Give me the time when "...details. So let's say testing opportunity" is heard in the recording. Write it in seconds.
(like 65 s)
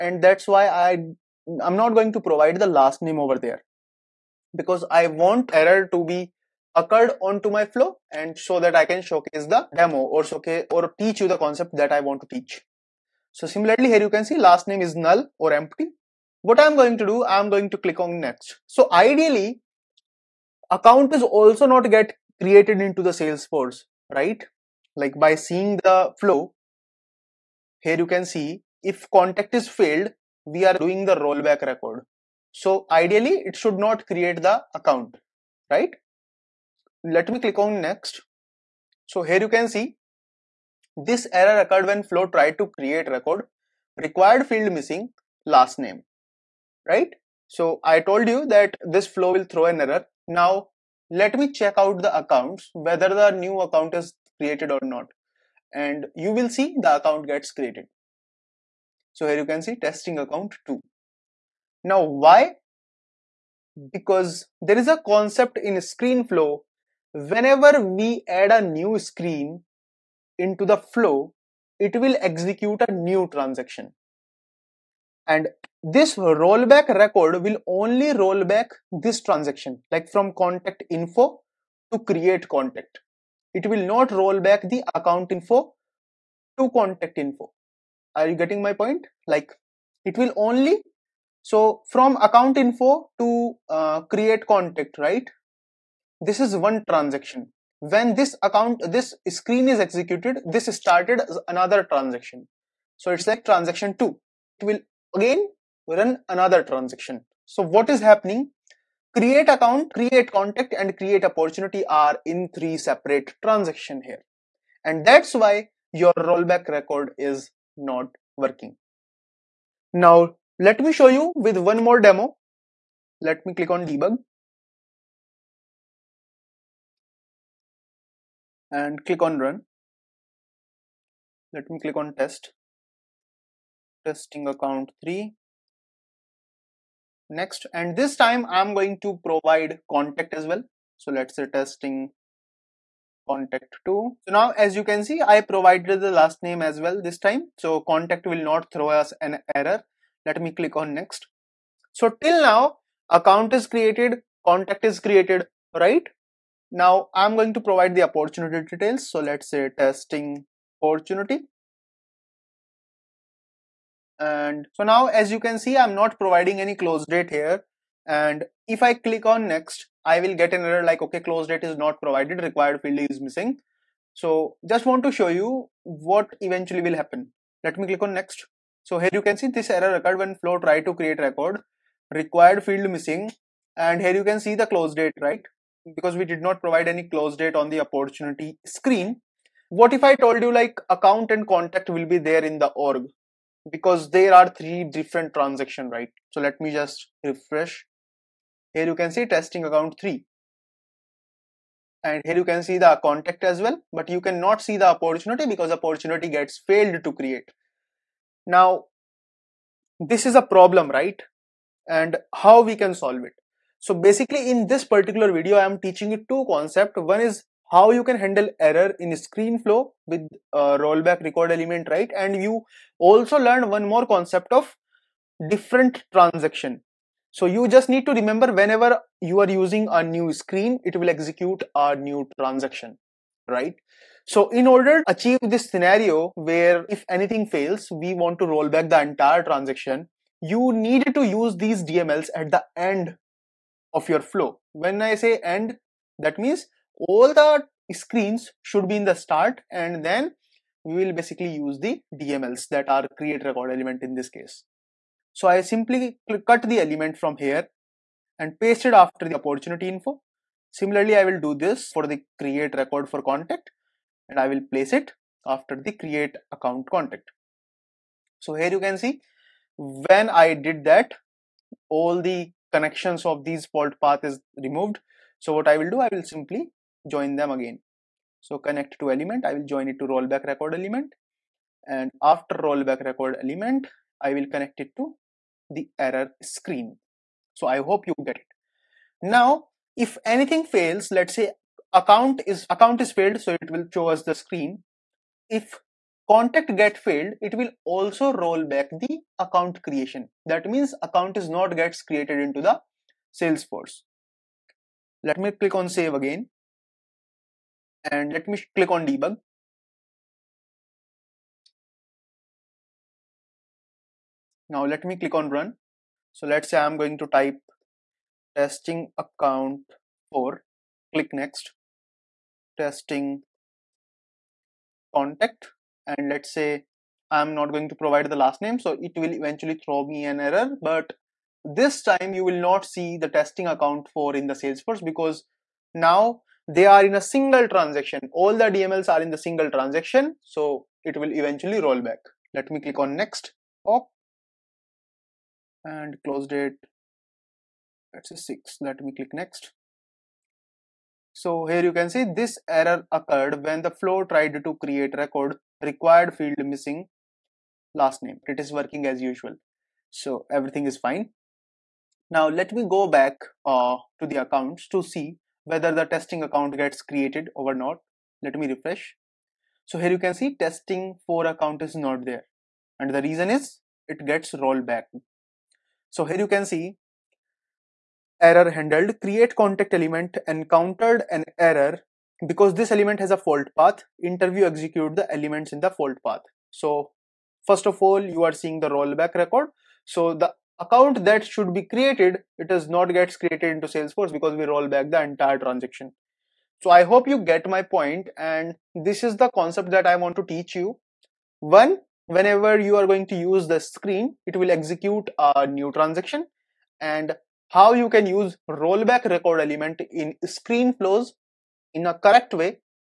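158 s.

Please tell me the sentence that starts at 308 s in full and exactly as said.
And let me click on debug.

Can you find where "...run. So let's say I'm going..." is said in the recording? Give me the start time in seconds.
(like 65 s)
315 s.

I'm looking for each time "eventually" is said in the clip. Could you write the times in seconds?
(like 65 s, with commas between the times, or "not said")
176 s, 329 s, 341 s.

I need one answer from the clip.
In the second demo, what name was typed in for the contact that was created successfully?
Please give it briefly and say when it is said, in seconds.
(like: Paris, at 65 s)
Testing contact 2, at 141 s.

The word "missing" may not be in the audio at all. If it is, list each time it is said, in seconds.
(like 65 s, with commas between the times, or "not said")
44 s, 173 s, 182 s, 356 s.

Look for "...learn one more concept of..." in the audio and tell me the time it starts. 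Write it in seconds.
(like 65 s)
223 s.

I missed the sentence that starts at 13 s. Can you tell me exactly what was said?
So similarly here you can see last name is null or empty.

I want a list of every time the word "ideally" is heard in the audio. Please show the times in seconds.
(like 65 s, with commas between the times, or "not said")
18 s, 32 s.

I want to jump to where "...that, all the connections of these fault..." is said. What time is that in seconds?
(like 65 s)
270 s.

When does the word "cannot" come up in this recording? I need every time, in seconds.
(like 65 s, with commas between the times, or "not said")
204 s.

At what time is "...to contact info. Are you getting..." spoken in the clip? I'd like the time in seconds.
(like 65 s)
86 s.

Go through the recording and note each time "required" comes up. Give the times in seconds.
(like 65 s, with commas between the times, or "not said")
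43 s, 172 s, 182 s, 355 s.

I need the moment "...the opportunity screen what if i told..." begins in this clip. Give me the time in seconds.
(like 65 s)
187 s.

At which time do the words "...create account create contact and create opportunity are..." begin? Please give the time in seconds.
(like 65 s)
109 s.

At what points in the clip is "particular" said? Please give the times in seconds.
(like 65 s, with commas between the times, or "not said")
214 s.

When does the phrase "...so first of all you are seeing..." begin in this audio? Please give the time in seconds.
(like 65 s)
386 s.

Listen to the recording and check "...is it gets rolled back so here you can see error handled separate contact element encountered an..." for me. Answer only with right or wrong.
wrong.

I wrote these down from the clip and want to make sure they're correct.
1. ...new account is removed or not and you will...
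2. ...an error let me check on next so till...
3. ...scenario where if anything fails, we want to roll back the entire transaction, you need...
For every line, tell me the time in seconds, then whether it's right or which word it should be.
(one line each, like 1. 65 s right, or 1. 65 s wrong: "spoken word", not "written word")
1. 53 s wrong: "created", not "removed"
2. 149 s wrong: "click", not "check"
3. 235 s right.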